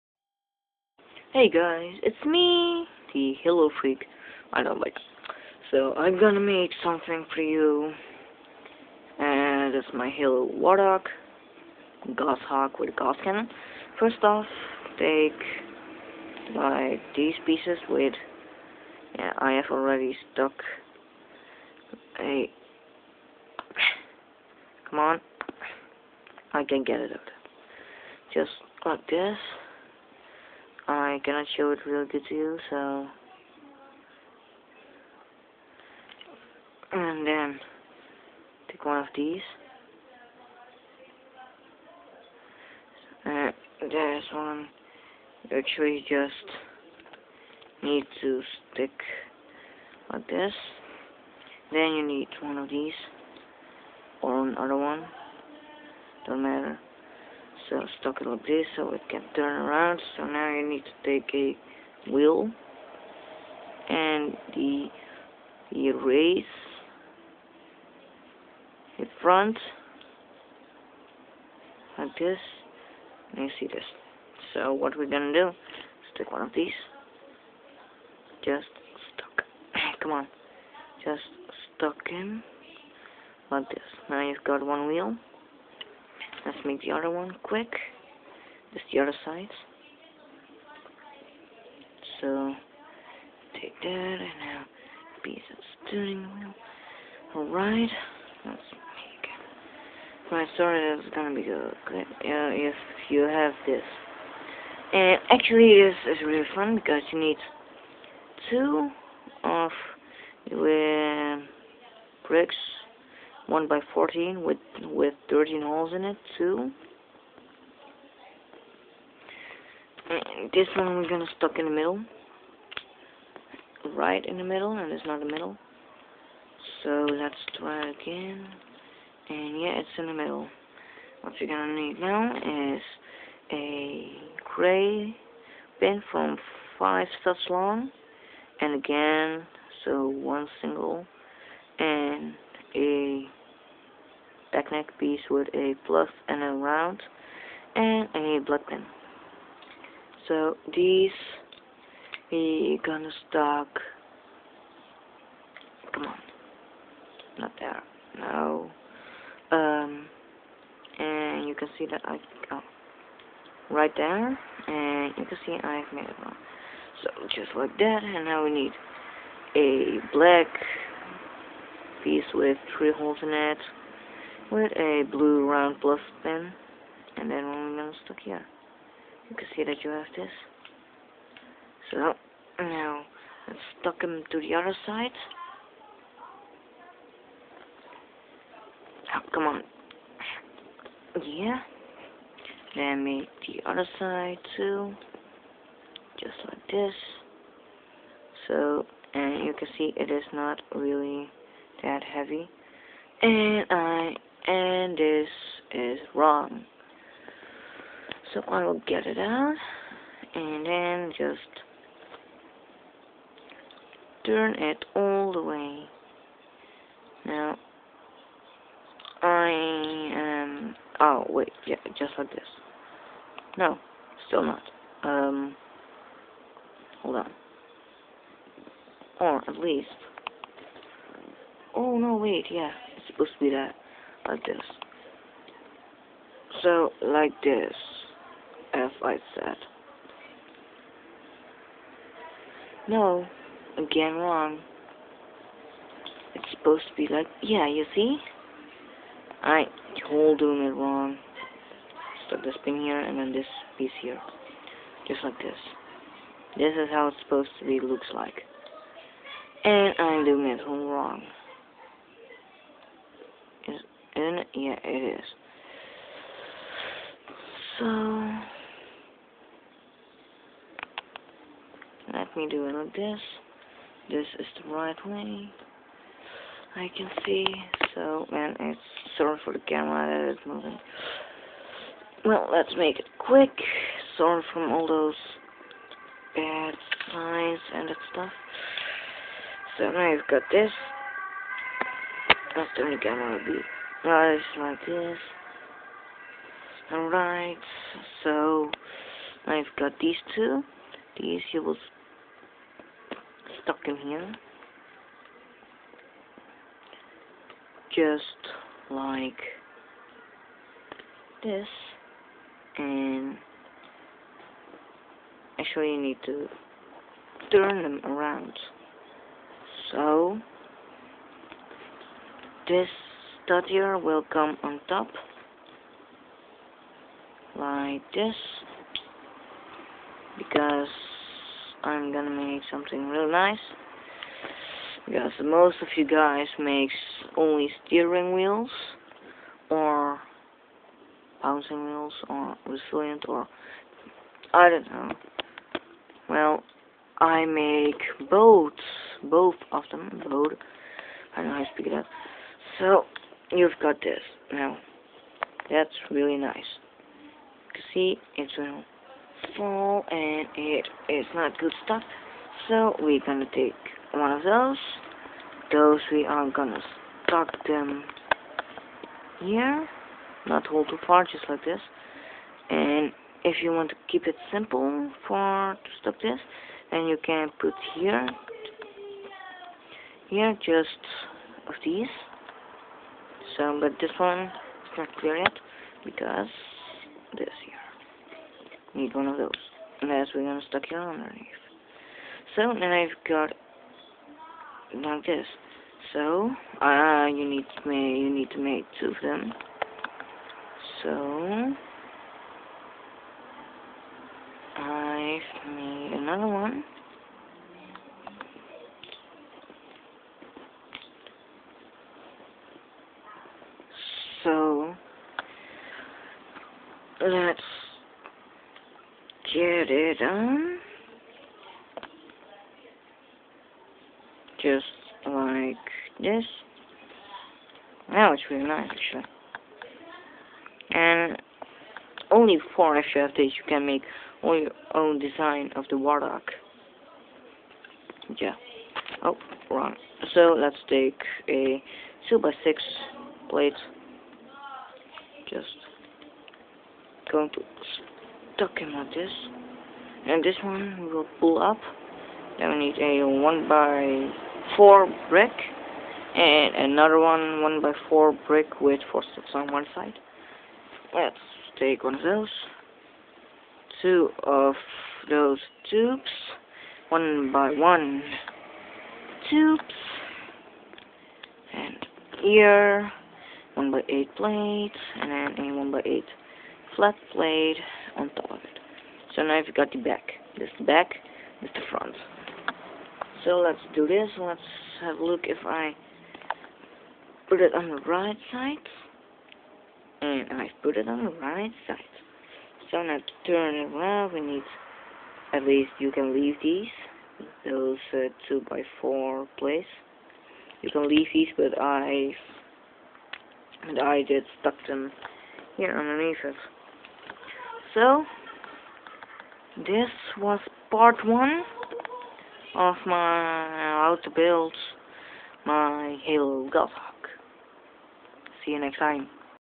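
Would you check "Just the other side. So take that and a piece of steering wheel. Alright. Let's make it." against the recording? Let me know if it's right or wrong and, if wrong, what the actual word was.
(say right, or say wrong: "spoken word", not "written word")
right.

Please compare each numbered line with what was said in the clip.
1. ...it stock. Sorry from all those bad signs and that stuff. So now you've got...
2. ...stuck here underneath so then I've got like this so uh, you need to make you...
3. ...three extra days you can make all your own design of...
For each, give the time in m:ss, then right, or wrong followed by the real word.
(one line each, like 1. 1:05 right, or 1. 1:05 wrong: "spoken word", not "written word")
1. 4:42 wrong: "quick", not "stock"
2. 6:30 right
3. 7:12 wrong: "four", not "three".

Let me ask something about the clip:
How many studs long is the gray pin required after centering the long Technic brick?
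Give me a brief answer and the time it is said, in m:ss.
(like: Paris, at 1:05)
5, at 2:16.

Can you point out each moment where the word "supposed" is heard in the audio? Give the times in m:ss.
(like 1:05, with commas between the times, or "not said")
3:53, 4:06, 4:17.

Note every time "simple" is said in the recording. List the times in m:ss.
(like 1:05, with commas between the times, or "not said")
6:14.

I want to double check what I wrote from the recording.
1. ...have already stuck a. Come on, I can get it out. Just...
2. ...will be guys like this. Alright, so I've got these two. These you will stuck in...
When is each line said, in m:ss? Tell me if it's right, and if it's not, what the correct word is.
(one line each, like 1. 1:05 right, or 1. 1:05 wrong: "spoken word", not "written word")
1. 0:19 right
2. 4:53 right.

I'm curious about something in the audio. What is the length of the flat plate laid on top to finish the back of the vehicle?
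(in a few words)
1 by 8.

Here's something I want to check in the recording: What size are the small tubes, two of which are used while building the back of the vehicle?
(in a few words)
1 by 1.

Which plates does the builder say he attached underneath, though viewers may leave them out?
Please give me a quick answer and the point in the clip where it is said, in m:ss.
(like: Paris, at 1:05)
2 by 4, at 8:18.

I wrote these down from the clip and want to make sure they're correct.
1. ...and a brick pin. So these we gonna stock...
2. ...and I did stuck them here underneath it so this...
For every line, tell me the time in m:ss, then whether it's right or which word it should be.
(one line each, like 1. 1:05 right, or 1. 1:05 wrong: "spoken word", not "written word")
1. 2:27 wrong: "black", not "brick"
2. 8:23 right.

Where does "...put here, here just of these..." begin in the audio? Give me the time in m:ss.
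6:17.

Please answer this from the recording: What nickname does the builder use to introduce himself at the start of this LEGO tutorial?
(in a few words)
The Halo Freak.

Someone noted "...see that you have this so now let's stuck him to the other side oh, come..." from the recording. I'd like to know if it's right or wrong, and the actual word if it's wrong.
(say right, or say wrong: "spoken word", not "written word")
right.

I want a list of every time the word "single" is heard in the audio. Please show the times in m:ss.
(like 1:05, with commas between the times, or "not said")
2:20.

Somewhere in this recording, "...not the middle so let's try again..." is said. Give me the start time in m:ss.
2:05.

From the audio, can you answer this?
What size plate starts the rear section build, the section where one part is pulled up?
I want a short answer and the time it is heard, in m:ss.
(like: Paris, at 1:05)
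2 by 6, at 7:22.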